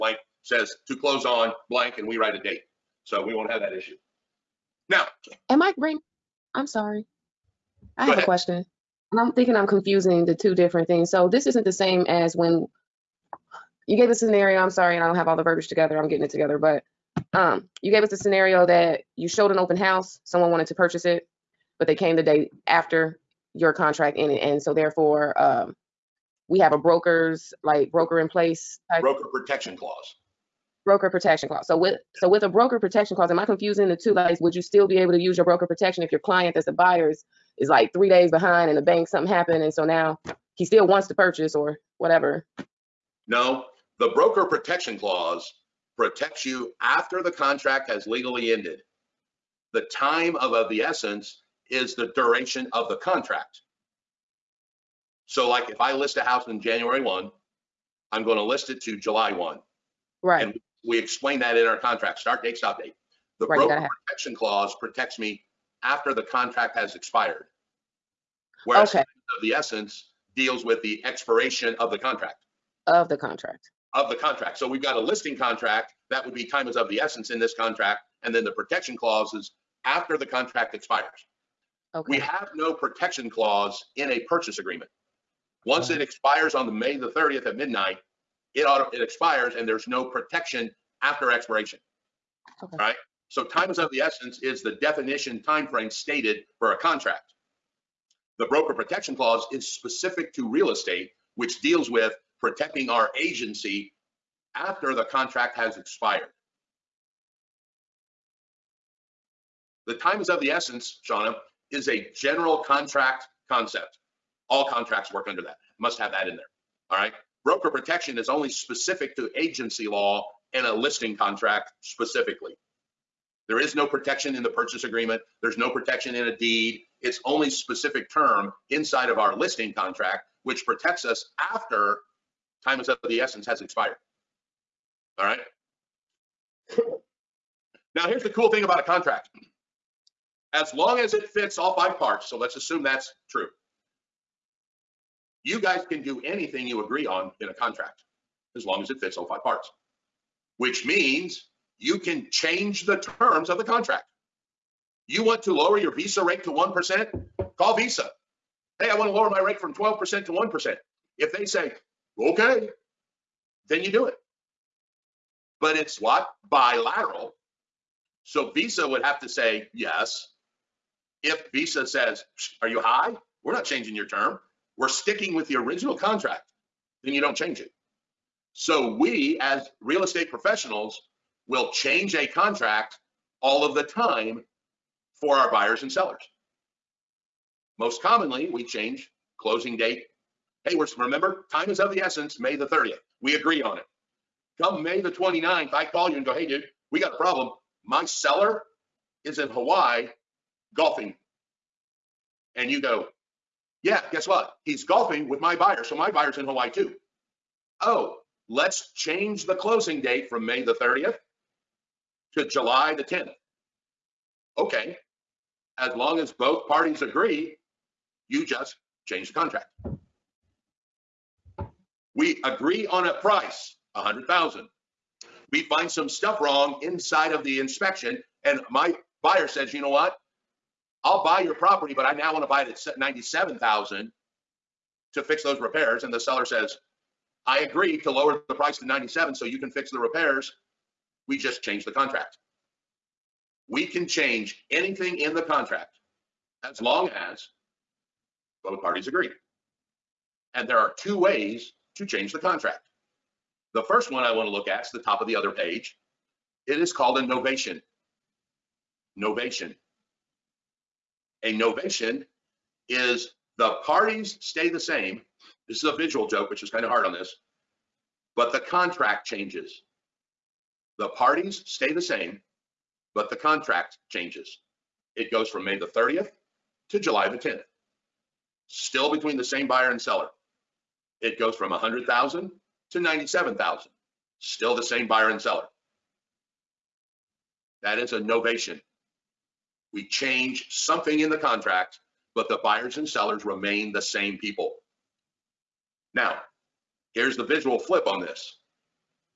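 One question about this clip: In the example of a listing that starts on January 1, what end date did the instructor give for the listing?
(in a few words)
July 1.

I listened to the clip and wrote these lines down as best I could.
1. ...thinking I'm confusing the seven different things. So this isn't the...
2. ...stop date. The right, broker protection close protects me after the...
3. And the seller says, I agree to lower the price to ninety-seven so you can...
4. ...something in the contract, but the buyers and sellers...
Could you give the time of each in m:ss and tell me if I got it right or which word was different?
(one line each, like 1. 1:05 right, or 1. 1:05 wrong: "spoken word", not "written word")
1. 0:09 wrong: "two", not "seven"
2. 1:02 wrong: "clause", not "close"
3. 3:56 right
4. 4:50 right.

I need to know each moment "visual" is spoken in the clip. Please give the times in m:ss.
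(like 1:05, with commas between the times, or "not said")
4:25, 4:57.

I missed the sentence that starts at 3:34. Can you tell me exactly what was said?
Okay, as long as both parties agree, you just change the contract.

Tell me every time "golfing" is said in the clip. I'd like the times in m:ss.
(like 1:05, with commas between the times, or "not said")
3:20, 3:24.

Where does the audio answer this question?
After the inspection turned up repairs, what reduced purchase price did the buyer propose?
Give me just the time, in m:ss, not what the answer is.
3:52.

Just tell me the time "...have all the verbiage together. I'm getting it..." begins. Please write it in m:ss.
0:15.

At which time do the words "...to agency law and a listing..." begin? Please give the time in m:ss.
1:59.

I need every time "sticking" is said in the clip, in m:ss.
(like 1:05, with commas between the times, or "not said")
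2:54.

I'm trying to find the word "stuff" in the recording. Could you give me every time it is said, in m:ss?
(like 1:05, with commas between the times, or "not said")
3:46.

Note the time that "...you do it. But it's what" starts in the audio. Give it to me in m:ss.
2:43.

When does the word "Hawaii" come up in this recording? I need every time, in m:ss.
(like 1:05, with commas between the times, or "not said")
3:19, 3:26.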